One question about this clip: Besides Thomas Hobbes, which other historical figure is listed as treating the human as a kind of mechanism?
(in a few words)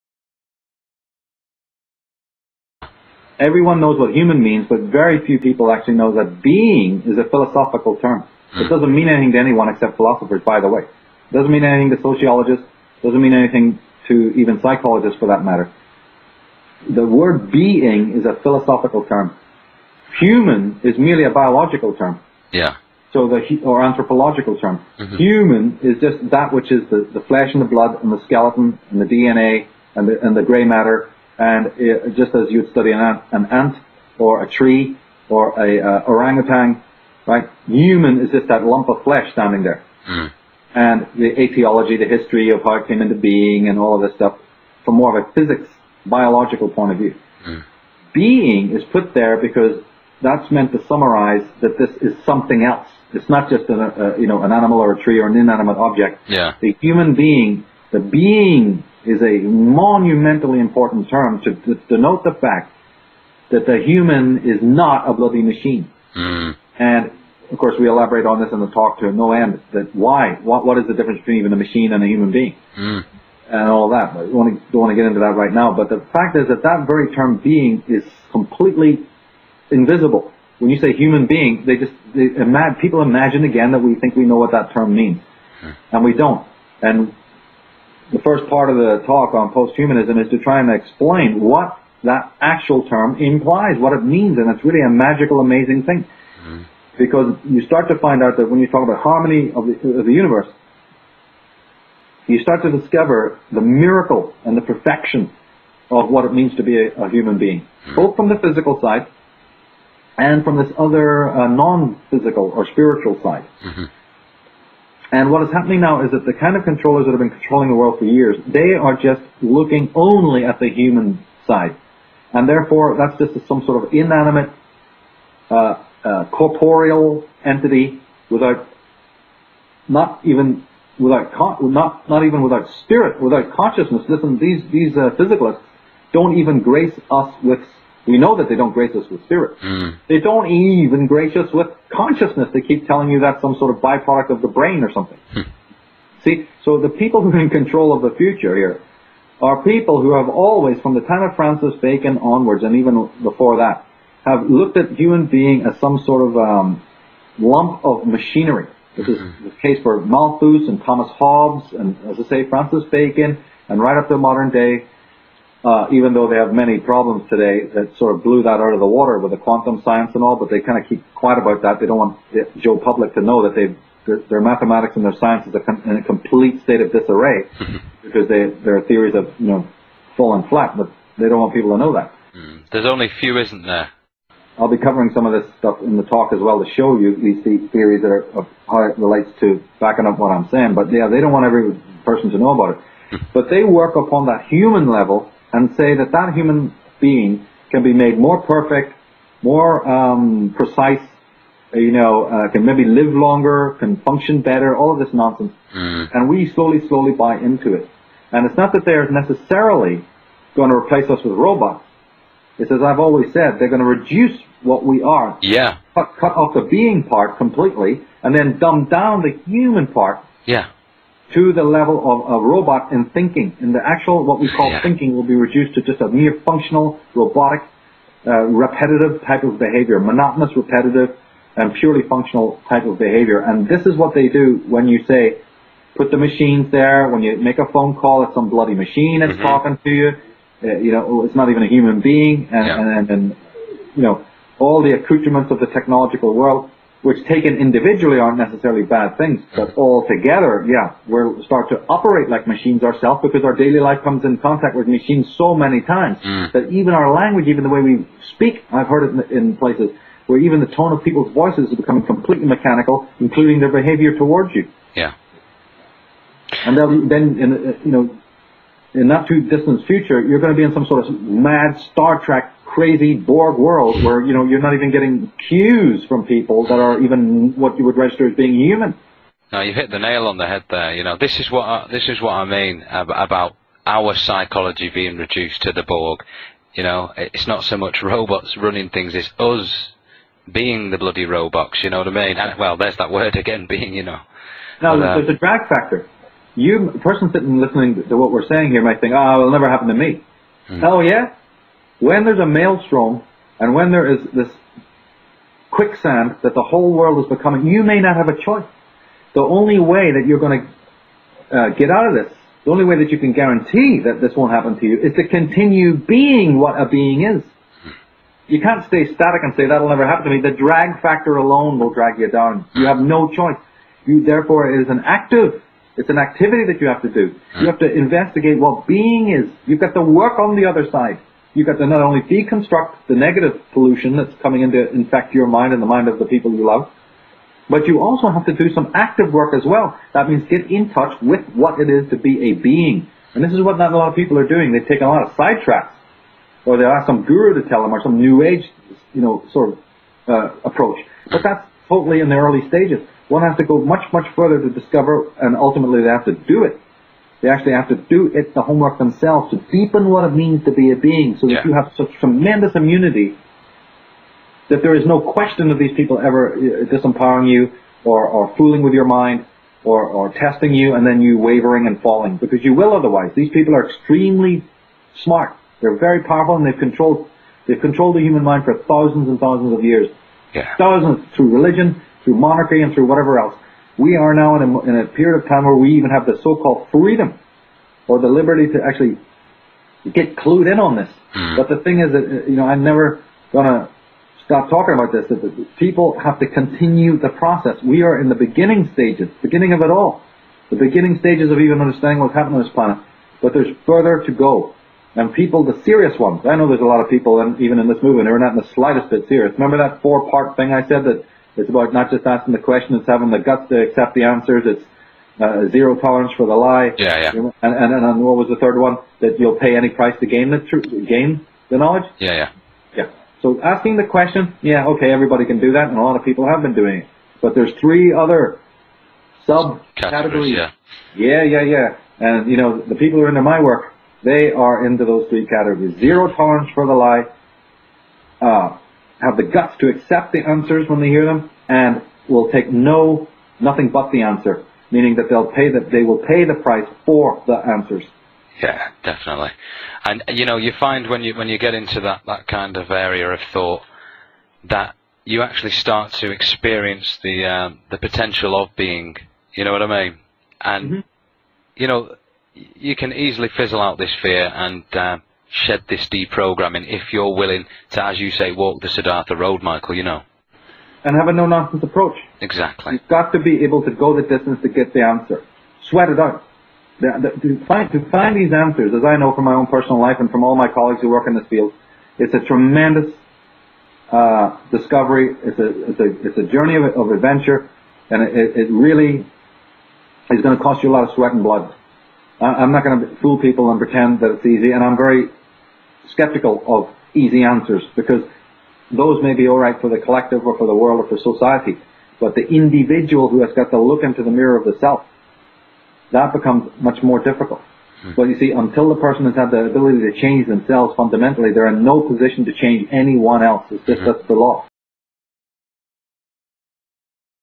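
Malthus.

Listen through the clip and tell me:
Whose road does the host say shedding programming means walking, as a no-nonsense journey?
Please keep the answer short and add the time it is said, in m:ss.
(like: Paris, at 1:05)
Siddhartha, at 7:48.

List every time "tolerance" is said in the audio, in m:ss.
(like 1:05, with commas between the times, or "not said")
6:55, 7:16.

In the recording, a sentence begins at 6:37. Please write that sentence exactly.
We are in the beginning stages, beginning of it all.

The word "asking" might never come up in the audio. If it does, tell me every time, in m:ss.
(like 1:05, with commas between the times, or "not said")
6:52, 7:03.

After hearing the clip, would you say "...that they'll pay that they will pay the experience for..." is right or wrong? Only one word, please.
wrong.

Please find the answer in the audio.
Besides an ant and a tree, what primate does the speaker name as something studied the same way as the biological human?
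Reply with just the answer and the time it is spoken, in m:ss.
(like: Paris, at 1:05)
orangutan, at 0:36.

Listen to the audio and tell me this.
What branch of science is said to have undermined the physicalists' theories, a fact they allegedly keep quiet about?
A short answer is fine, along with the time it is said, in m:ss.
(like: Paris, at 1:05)
quantum science, at 2:49.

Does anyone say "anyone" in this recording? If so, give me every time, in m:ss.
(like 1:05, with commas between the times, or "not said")
0:09, 8:32.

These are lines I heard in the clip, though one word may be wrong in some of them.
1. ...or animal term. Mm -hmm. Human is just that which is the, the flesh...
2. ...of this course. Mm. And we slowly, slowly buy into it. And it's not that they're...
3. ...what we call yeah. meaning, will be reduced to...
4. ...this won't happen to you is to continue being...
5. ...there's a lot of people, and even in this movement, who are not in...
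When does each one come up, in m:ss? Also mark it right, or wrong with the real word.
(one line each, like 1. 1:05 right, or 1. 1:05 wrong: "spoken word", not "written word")
1. 0:23 wrong: "anthropological", not "animal"
2. 3:24 wrong: "nonsense", not "course"
3. 3:44 wrong: "thinking", not "meaning"
4. 5:14 right
5. 6:46 right.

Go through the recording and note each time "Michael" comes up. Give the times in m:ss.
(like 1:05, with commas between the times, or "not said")
7:49.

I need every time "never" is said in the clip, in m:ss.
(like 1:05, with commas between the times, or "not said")
4:59, 5:19, 6:32.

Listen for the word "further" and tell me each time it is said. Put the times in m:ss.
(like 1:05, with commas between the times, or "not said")
5:54, 6:43.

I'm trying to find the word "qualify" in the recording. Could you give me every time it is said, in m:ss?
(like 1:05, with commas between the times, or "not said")
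not said.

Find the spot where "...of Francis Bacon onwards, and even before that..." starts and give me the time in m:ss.
2:31.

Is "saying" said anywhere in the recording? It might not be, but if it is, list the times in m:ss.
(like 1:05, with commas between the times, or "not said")
3:10, 4:58.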